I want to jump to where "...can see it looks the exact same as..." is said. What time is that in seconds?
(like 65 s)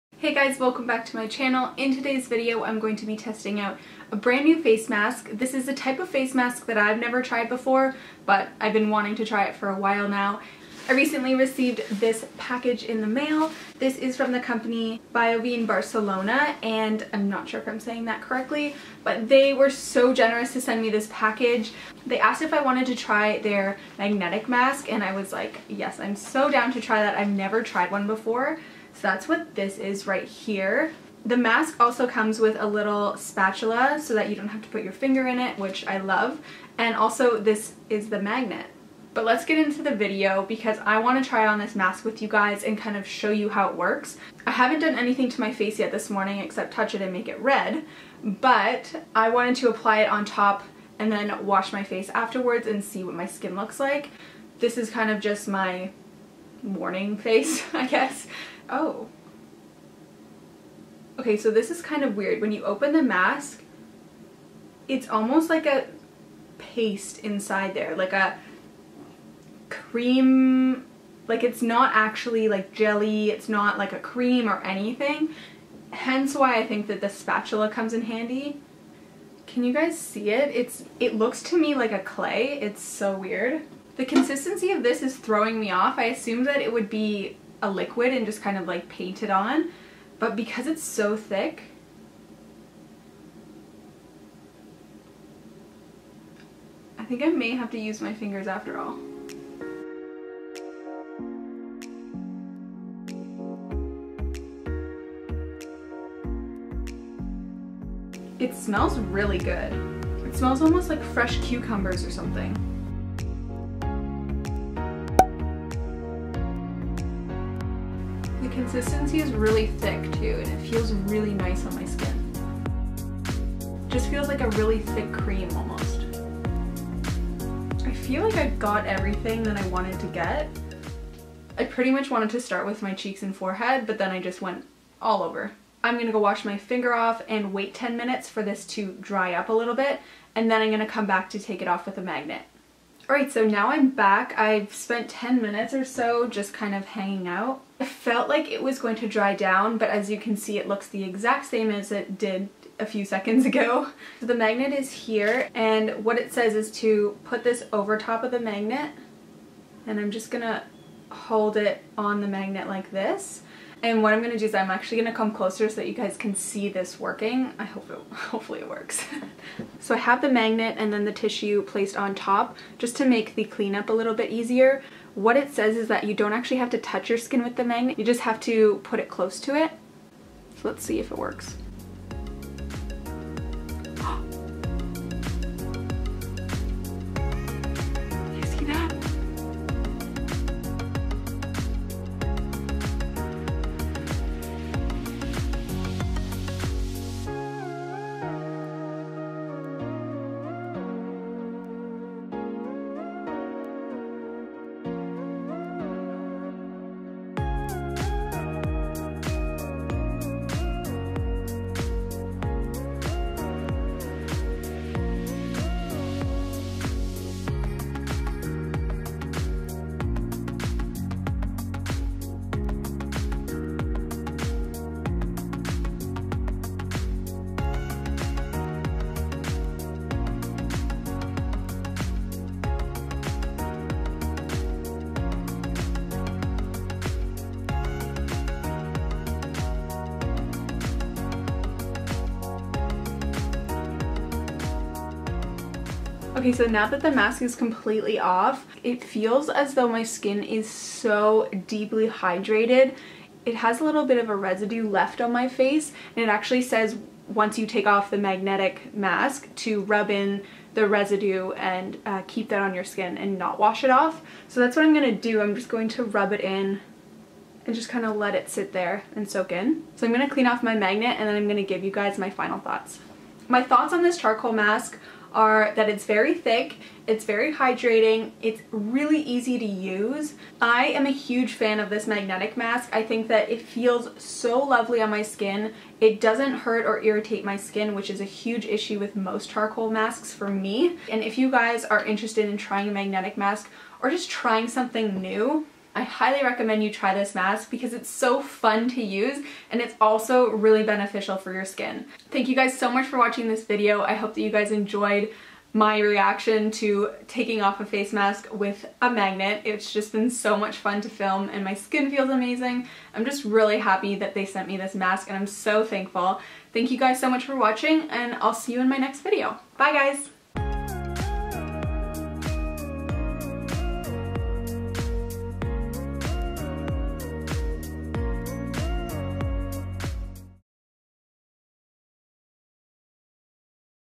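150 s.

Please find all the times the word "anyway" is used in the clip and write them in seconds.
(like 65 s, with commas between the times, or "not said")
not said.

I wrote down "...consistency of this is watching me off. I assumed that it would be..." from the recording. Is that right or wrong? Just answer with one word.
wrong.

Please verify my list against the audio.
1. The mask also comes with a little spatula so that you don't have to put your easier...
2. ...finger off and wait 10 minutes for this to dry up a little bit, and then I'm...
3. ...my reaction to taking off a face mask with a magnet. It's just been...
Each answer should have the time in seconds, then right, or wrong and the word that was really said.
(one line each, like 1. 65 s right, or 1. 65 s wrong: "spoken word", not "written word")
1. 31 s wrong: "finger", not "easier"
2. 136 s right
3. 305 s right.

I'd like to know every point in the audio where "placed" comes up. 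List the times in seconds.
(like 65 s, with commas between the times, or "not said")
171 s.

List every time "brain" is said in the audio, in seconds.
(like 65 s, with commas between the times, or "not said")
not said.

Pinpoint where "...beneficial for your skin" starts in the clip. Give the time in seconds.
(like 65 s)
300 s.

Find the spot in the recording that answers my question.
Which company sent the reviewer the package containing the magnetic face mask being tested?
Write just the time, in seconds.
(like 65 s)
15 s.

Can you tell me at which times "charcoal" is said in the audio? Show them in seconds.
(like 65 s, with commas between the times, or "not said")
274 s, 289 s.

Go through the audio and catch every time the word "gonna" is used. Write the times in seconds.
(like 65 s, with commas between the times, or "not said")
135 s, 140 s, 160 s.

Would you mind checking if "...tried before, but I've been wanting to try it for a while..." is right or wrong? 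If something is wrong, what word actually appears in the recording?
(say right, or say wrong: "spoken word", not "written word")
right.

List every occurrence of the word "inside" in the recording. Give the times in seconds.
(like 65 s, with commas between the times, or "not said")
67 s.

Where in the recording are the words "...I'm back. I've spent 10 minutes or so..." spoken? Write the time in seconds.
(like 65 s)
143 s.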